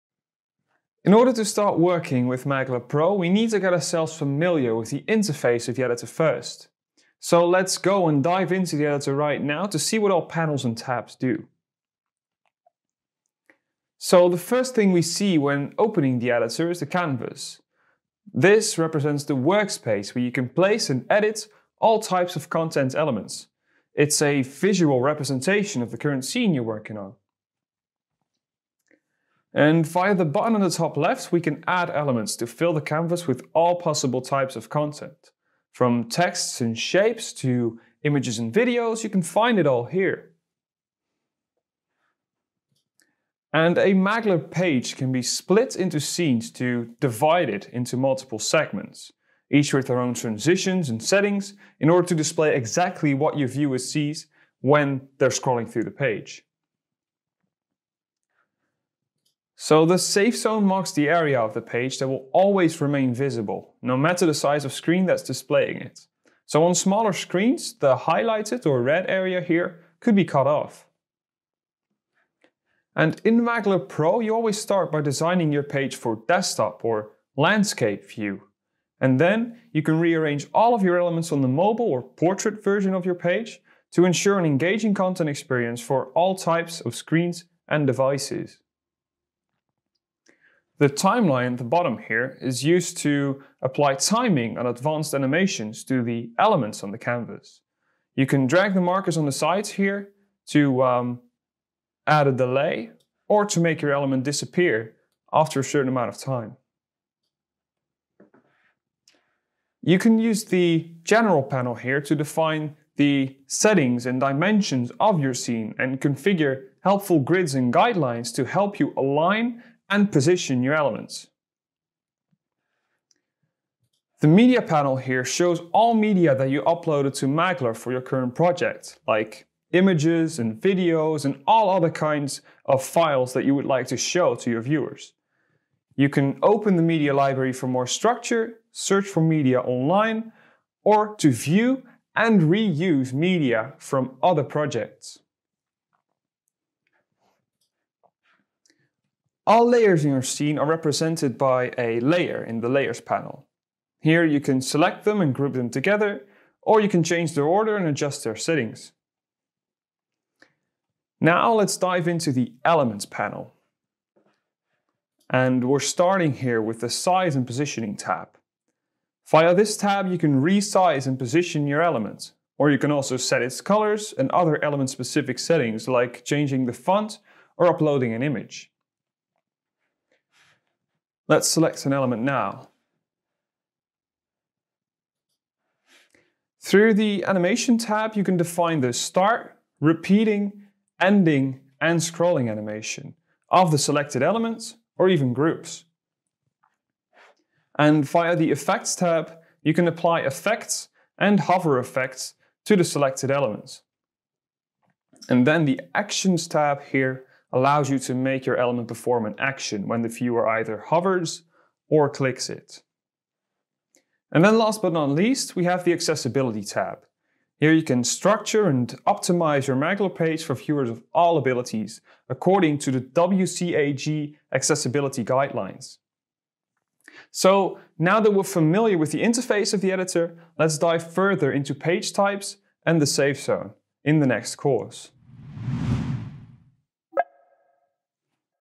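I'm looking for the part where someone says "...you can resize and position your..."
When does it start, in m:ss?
2:50.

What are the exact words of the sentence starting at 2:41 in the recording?
Now let's dive into the elements panel.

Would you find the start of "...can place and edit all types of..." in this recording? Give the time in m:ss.
0:20.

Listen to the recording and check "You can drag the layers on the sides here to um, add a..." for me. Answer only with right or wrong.
wrong.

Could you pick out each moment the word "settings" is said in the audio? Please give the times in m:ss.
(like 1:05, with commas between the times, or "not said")
0:51, 1:53, 2:38, 2:55.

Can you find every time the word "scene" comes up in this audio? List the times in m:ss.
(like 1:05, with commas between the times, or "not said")
0:26, 0:45, 1:55, 2:30.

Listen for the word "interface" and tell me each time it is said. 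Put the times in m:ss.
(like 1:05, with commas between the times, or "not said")
0:05, 3:49.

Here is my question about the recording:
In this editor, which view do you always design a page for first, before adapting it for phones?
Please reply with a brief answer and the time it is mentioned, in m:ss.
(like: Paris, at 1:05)
Desktop or landscape, at 1:16.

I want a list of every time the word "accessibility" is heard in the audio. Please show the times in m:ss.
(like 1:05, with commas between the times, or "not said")
3:35, 3:44.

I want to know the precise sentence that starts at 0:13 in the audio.
So the first thing we see when opening the editor is the canvas.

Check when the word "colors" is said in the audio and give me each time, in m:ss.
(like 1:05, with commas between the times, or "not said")
2:53.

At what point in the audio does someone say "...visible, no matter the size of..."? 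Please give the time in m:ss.
1:03.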